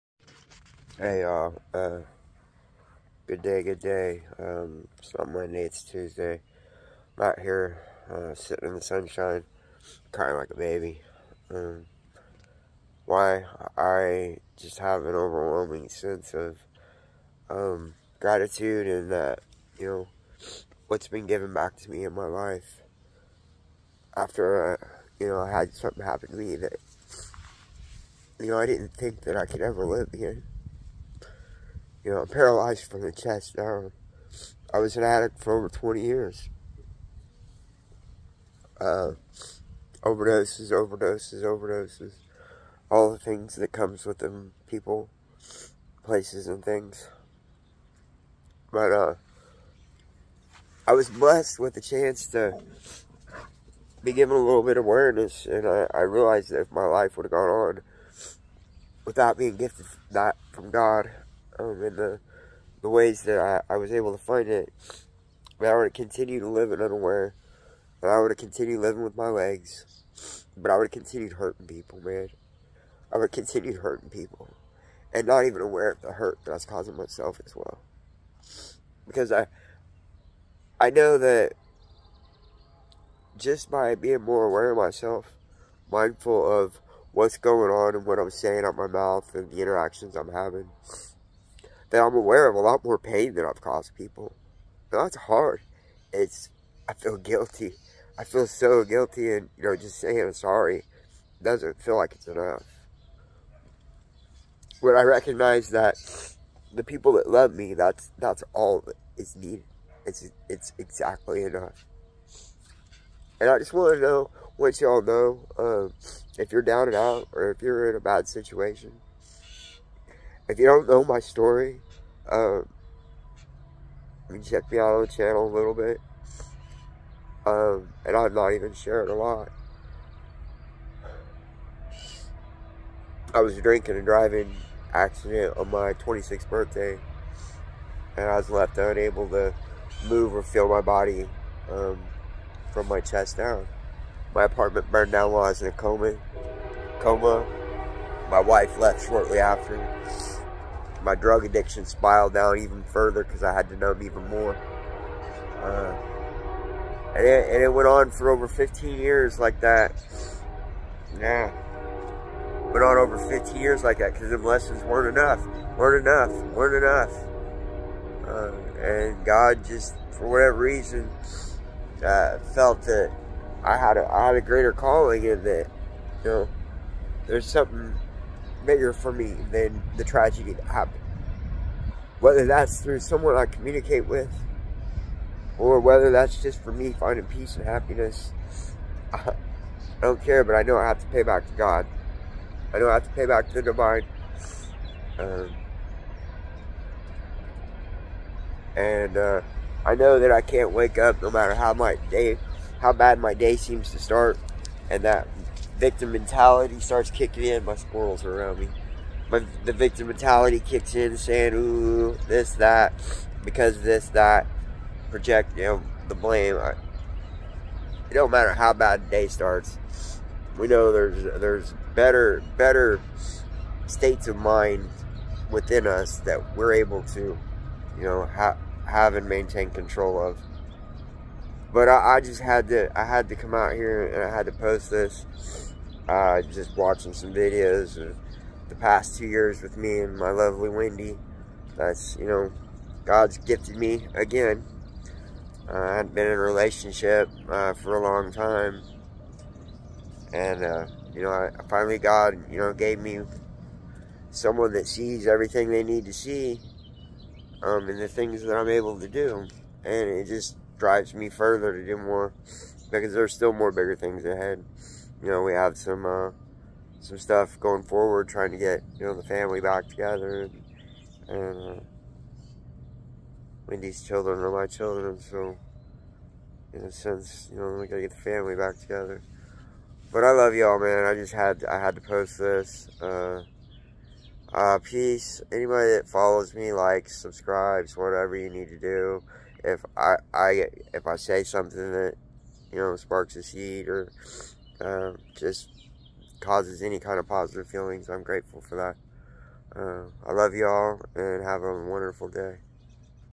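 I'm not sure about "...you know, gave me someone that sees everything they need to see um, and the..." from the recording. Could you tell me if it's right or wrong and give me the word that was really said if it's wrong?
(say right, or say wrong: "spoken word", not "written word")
right.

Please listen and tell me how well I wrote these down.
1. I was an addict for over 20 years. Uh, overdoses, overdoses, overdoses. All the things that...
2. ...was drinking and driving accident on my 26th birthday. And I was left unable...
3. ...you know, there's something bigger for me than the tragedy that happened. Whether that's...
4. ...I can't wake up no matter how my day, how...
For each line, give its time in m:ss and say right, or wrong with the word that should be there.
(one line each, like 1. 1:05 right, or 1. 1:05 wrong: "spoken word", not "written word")
1. 0:34 right
2. 2:13 right
3. 2:56 right
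4. 3:20 right.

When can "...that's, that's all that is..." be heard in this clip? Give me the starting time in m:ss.
1:47.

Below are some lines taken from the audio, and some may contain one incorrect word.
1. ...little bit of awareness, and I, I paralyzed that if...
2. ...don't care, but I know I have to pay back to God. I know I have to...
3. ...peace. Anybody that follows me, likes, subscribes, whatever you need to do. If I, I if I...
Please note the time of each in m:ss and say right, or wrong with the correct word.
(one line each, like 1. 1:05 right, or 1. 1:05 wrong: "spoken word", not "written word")
1. 0:54 wrong: "realized", not "paralyzed"
2. 3:10 right
3. 4:44 right.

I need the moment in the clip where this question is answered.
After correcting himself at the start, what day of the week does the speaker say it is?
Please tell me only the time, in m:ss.
0:05.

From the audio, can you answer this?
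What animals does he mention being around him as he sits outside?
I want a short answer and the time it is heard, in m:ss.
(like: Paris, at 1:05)
Squirrels, at 3:27.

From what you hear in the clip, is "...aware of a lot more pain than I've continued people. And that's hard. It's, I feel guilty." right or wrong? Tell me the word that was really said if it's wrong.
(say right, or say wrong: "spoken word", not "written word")
wrong: "caused", not "continued".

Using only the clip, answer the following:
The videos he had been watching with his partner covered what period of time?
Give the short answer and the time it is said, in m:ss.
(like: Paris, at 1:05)
The past two years, at 3:58.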